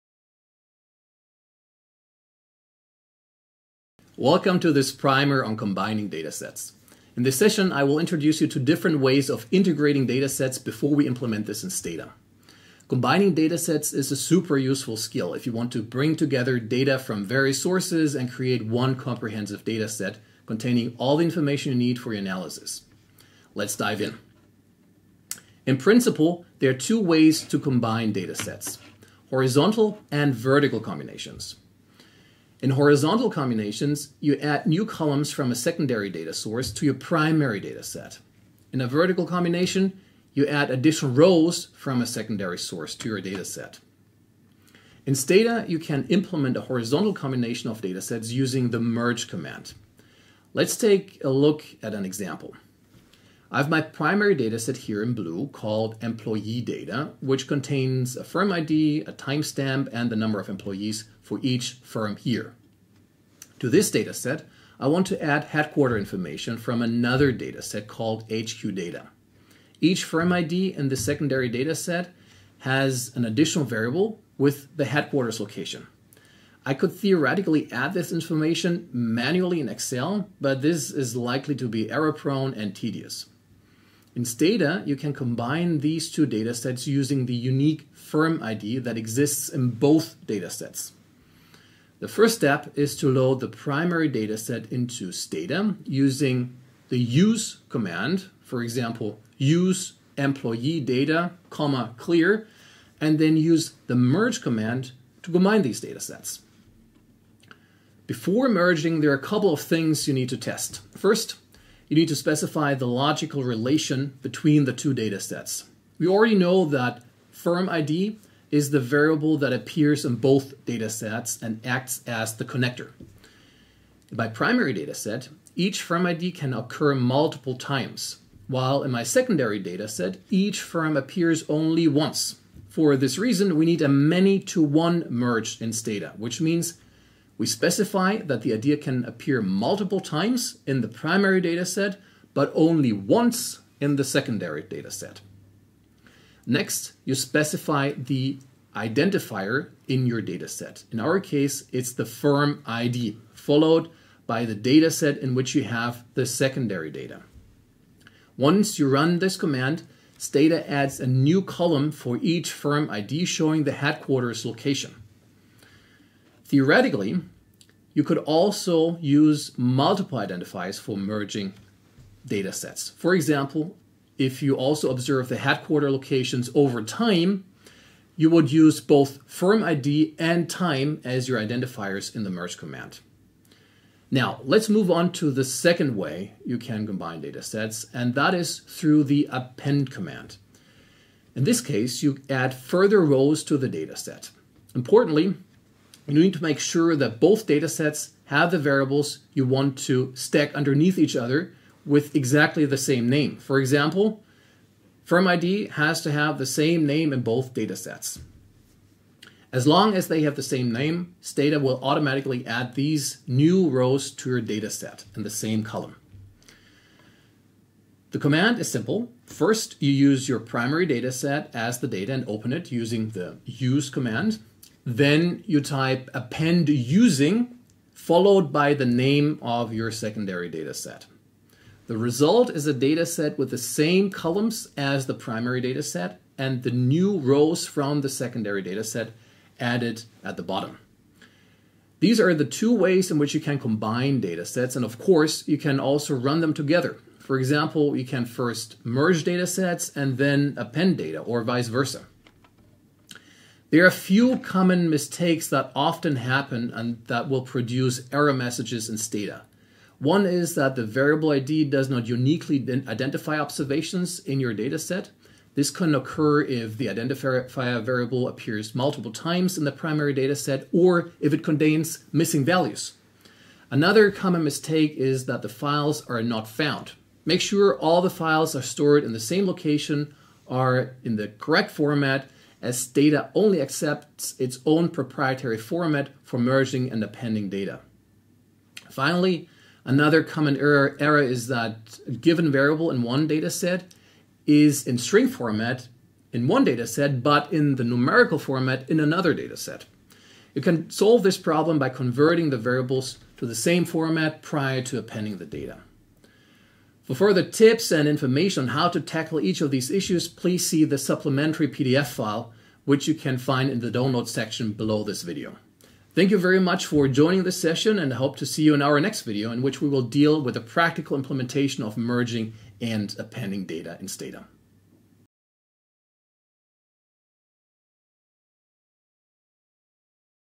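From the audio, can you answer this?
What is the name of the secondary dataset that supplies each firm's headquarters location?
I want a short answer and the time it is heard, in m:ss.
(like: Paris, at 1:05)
HQ data, at 1:08.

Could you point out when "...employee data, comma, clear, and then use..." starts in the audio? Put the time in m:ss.
1:40.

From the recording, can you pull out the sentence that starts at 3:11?
In this case, you add further rows to the data set.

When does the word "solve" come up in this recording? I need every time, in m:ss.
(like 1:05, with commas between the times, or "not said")
5:00.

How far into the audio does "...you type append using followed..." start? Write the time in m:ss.
3:45.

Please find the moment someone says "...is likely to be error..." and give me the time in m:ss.
1:20.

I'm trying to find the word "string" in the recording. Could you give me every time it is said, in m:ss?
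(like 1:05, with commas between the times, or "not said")
4:54.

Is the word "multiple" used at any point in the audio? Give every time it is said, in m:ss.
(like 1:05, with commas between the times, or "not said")
2:06, 2:19, 2:49, 4:28.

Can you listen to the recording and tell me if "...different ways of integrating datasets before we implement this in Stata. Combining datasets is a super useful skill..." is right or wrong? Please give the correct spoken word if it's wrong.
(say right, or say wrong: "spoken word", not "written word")
right.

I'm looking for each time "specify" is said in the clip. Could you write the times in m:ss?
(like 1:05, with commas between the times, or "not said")
1:52, 2:17, 2:27.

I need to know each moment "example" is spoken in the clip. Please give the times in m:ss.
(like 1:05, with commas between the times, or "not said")
0:52, 1:38, 2:53, 3:23, 4:07.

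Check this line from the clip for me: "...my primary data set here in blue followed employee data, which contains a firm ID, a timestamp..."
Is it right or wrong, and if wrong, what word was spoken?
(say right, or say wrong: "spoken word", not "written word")
wrong: "called", not "followed".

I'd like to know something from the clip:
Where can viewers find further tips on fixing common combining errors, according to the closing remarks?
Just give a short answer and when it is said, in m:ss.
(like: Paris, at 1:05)
supplementary PDF file, at 5:10.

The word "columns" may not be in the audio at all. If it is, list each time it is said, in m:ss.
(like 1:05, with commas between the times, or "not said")
0:34, 2:41, 3:35, 3:54.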